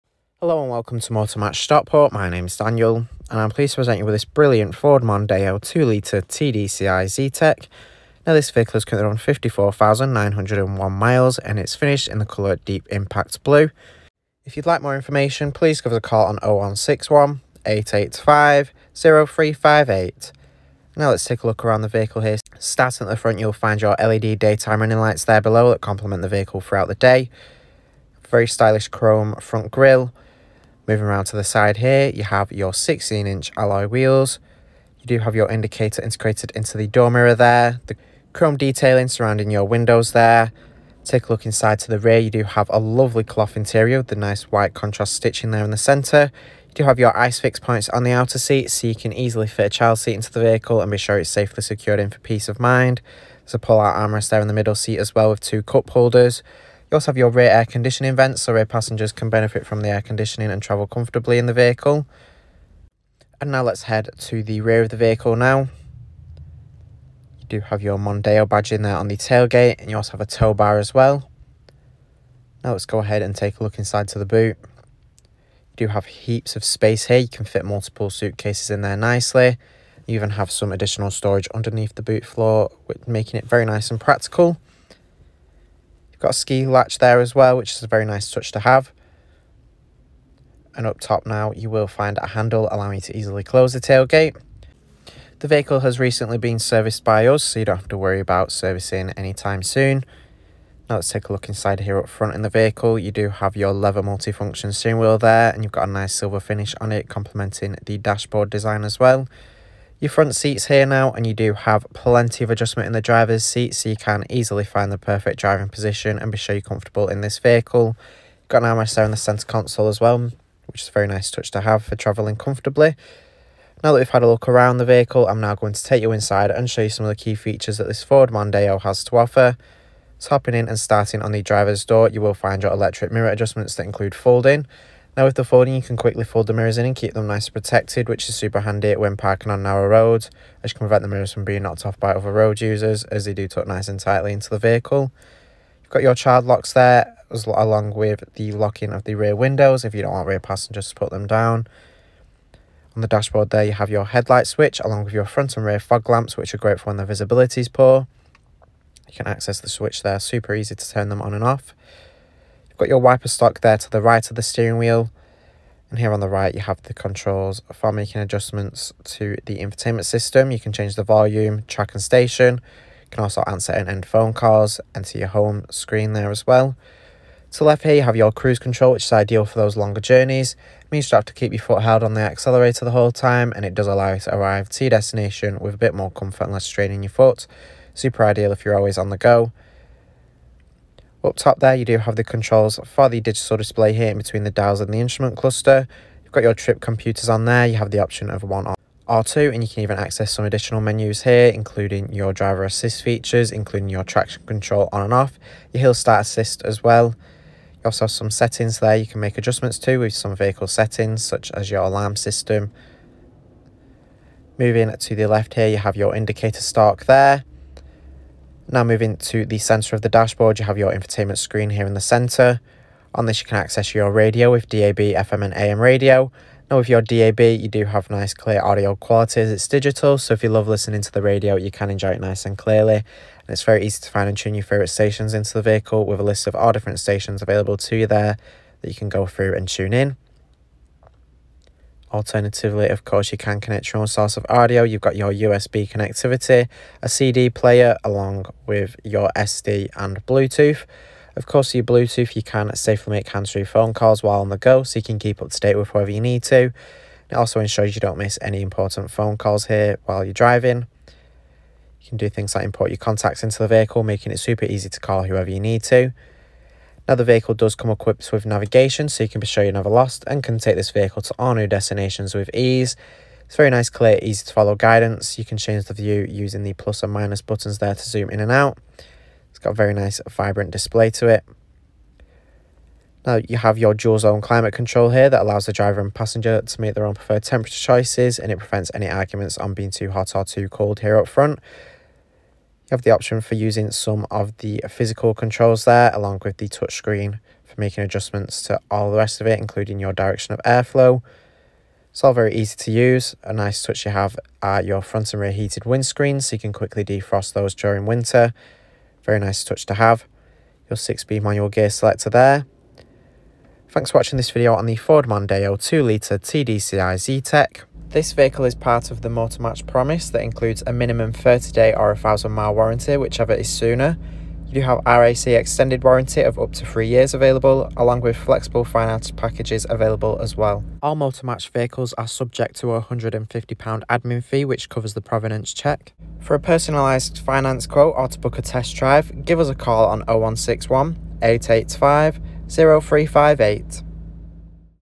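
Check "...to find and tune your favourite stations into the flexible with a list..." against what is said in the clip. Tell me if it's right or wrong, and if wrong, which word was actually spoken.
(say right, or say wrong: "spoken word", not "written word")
wrong: "vehicle", not "flexible".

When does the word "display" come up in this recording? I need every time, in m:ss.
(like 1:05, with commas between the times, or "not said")
3:13, 4:40.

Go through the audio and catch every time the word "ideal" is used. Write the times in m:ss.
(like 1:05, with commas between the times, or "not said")
2:59, 3:08.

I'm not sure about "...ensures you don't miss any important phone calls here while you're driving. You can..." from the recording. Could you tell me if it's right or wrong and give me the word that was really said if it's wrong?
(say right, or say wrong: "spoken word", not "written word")
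right.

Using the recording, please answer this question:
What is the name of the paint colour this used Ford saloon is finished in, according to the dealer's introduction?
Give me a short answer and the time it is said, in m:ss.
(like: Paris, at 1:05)
Deep Impact Blue, at 0:12.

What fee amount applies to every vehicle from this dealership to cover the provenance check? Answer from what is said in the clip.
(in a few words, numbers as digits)
£150.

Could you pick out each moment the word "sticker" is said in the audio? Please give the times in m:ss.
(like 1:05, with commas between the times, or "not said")
not said.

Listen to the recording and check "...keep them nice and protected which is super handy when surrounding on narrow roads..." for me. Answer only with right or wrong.
wrong.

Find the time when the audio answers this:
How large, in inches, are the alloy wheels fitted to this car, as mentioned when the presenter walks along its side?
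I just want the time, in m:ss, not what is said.
0:32.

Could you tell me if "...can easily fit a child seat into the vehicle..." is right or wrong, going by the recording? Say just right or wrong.
right.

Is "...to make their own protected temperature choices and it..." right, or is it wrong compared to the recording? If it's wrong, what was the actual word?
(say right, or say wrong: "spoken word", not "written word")
wrong: "preferred", not "protected".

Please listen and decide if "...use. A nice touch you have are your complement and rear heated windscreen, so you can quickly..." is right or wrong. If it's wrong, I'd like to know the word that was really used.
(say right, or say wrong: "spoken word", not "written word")
wrong: "front", not "complement".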